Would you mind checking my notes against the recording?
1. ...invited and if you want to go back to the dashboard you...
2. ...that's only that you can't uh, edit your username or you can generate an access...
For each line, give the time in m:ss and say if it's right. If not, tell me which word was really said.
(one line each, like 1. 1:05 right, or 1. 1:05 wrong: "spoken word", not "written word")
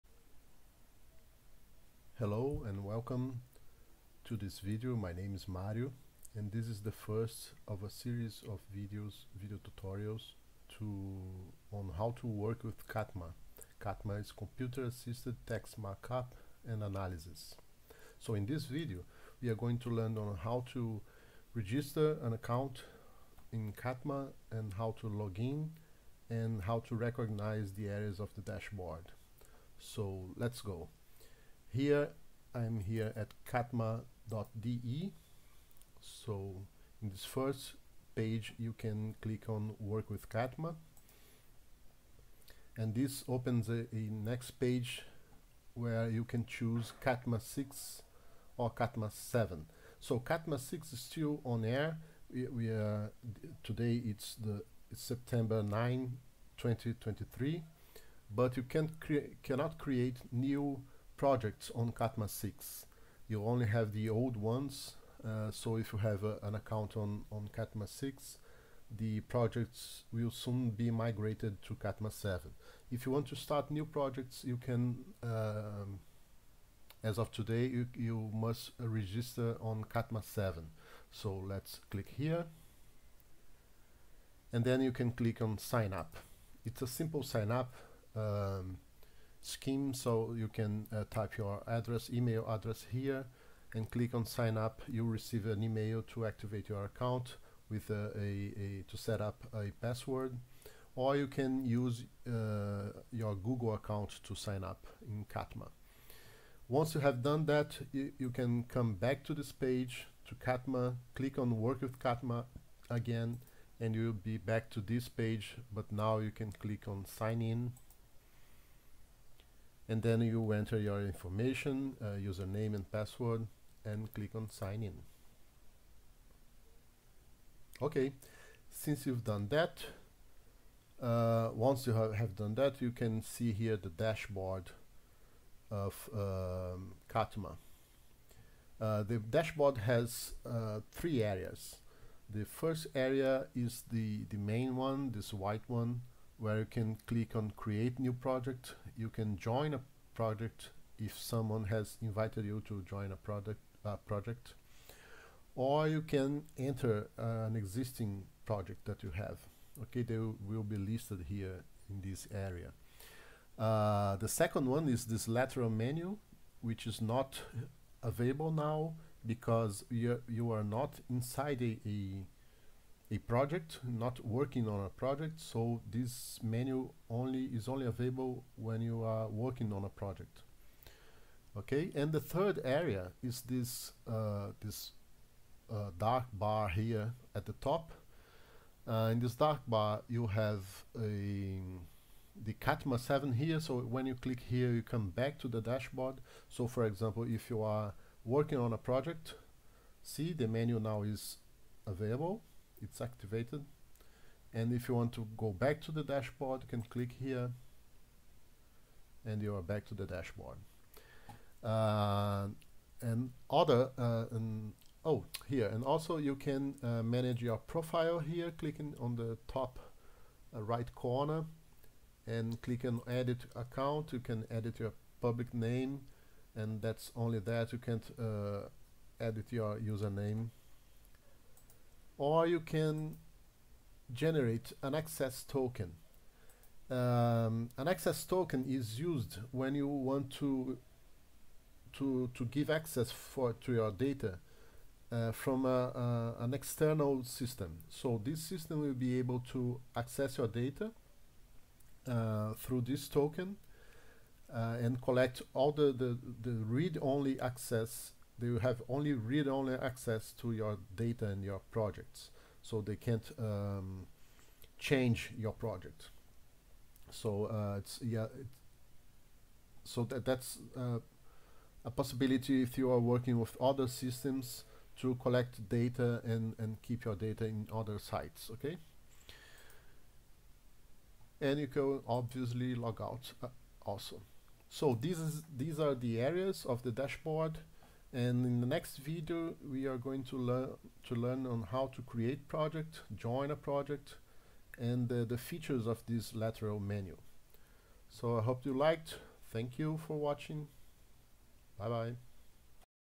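1. 3:23 wrong: "activated", not "invited"
2. 3:46 right.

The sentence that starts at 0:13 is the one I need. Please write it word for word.
CATMA is computer assisted text markup and analysis.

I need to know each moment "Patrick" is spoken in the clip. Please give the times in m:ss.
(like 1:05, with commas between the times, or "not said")
not said.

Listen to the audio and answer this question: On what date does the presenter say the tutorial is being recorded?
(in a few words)
September 9, 2023.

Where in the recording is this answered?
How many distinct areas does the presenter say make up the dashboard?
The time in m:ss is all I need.
2:20.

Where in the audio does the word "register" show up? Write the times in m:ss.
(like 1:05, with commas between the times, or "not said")
0:21, 1:18.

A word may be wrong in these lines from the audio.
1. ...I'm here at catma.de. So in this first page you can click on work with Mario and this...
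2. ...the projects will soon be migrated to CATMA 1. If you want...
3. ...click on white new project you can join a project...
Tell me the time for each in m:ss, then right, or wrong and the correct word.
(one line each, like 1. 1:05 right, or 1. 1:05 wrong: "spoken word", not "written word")
1. 0:32 wrong: "CATMA", not "Mario"
2. 1:08 wrong: "7", not "1"
3. 2:27 wrong: "create", not "white".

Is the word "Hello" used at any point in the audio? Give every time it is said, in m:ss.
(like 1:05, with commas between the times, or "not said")
0:02.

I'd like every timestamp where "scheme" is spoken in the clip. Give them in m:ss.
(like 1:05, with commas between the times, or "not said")
1:29.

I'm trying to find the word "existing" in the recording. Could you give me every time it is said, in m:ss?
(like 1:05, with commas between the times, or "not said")
2:37.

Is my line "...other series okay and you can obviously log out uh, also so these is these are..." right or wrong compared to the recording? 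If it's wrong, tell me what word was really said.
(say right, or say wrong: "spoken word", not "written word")
wrong: "sites", not "series".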